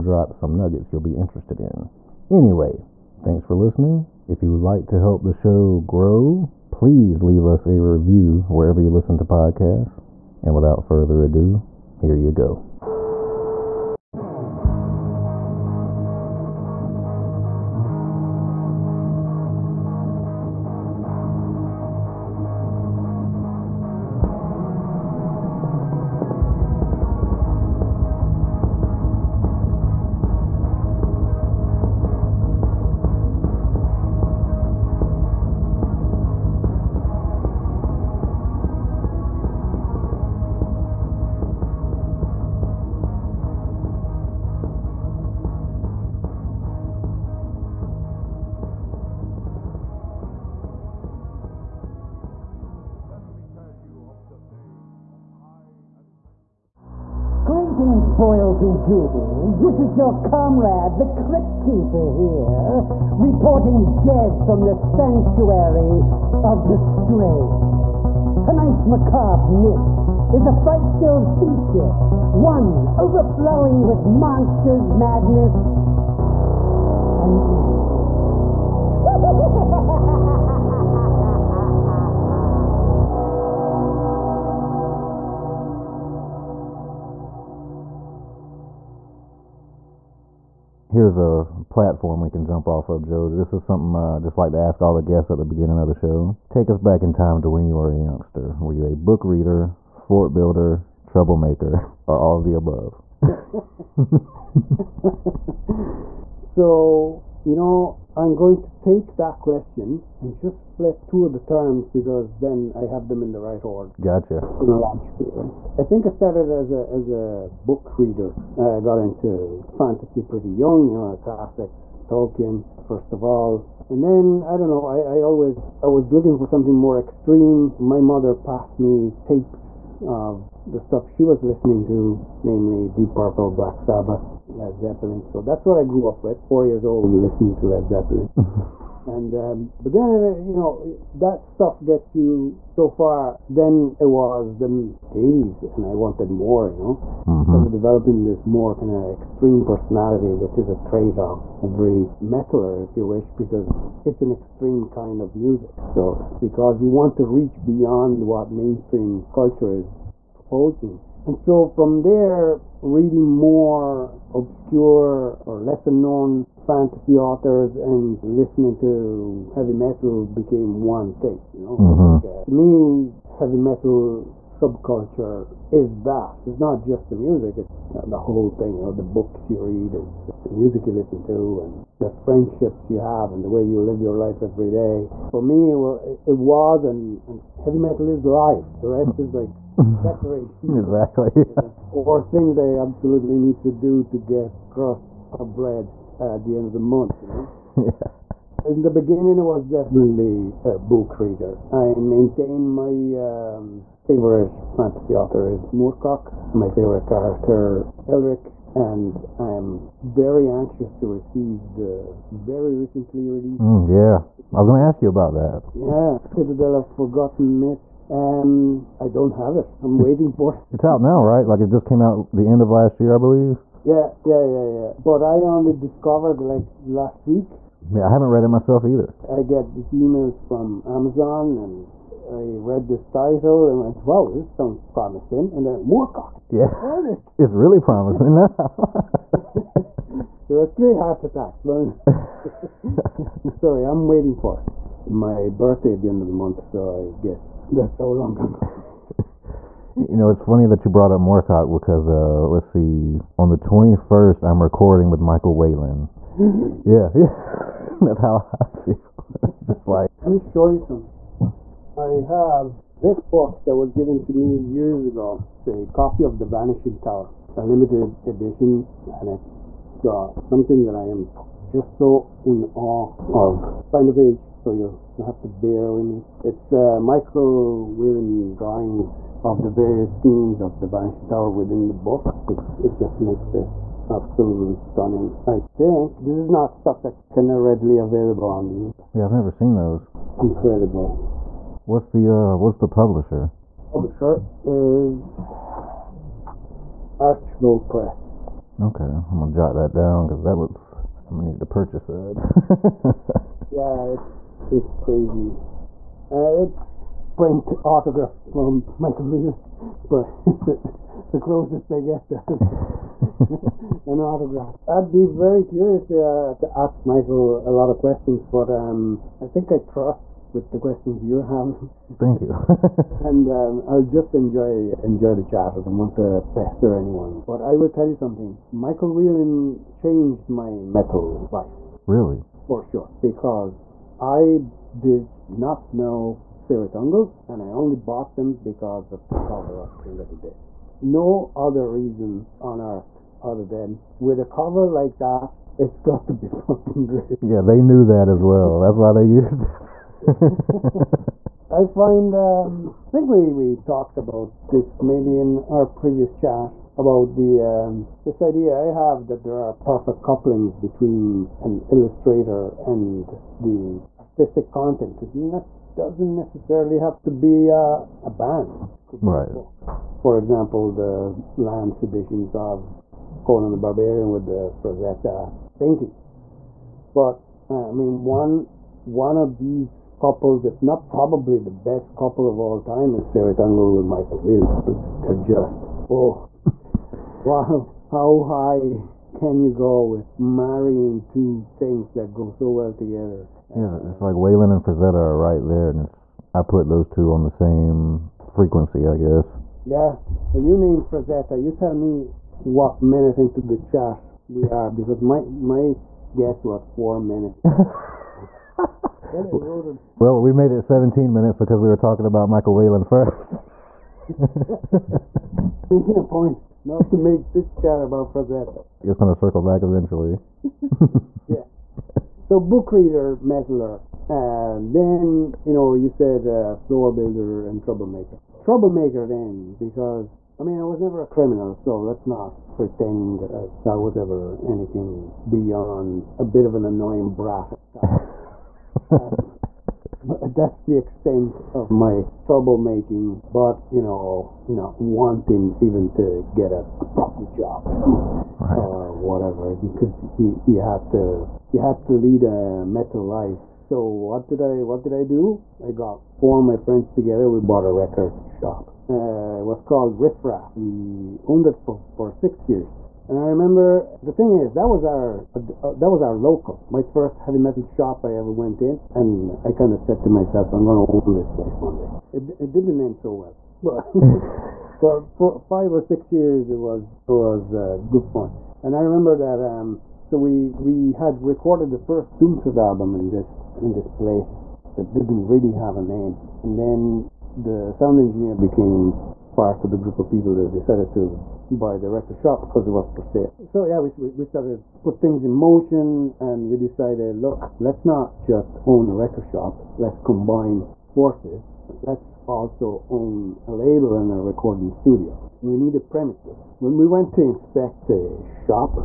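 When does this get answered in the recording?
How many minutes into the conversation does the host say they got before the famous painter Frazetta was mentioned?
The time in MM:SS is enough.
06:50.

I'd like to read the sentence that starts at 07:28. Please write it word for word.
or whatever, because you, you had to you had to lead a metal life.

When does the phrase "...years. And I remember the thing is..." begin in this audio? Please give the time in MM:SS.
07:42.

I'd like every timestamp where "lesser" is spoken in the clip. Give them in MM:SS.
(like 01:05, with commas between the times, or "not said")
02:45.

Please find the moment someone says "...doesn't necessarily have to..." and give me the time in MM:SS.
06:05.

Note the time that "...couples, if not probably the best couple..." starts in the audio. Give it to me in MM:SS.
06:20.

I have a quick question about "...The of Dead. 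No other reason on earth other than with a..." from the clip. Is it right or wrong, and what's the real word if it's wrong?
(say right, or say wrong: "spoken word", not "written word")
right.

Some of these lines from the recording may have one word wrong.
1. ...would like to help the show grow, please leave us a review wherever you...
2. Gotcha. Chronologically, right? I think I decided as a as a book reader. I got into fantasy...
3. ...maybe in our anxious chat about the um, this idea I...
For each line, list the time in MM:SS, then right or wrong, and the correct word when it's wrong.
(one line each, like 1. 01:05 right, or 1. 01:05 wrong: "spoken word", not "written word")
1. 00:04 right
2. 01:53 wrong: "started", not "decided"
3. 05:55 wrong: "previous", not "anxious".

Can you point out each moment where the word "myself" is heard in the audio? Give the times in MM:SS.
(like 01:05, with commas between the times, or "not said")
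03:48, 07:50.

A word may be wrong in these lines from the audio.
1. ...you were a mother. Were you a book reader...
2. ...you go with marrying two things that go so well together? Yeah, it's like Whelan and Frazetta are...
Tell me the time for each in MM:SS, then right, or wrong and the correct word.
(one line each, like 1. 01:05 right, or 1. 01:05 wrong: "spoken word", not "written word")
1. 01:37 wrong: "youngster", not "mother"
2. 06:29 right.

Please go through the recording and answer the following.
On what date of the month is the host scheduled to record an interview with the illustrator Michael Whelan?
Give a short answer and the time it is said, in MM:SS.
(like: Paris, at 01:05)
21st, at 04:13.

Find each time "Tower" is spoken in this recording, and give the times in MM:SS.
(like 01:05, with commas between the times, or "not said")
04:26, 04:41.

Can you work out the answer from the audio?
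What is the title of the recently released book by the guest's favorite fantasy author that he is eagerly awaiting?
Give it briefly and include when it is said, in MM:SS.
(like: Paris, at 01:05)
Citadel of Forgotten Myths, at 03:36.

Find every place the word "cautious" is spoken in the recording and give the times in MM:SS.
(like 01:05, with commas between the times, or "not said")
not said.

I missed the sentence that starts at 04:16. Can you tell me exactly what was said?
yeah, yeah, that's how I feel.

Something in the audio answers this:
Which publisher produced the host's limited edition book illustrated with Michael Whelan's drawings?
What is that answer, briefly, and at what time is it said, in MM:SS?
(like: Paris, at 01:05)
Archville Press, at 04:57.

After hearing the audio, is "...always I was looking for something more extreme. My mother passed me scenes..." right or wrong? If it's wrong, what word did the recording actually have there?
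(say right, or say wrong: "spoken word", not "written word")
wrong: "tapes", not "scenes".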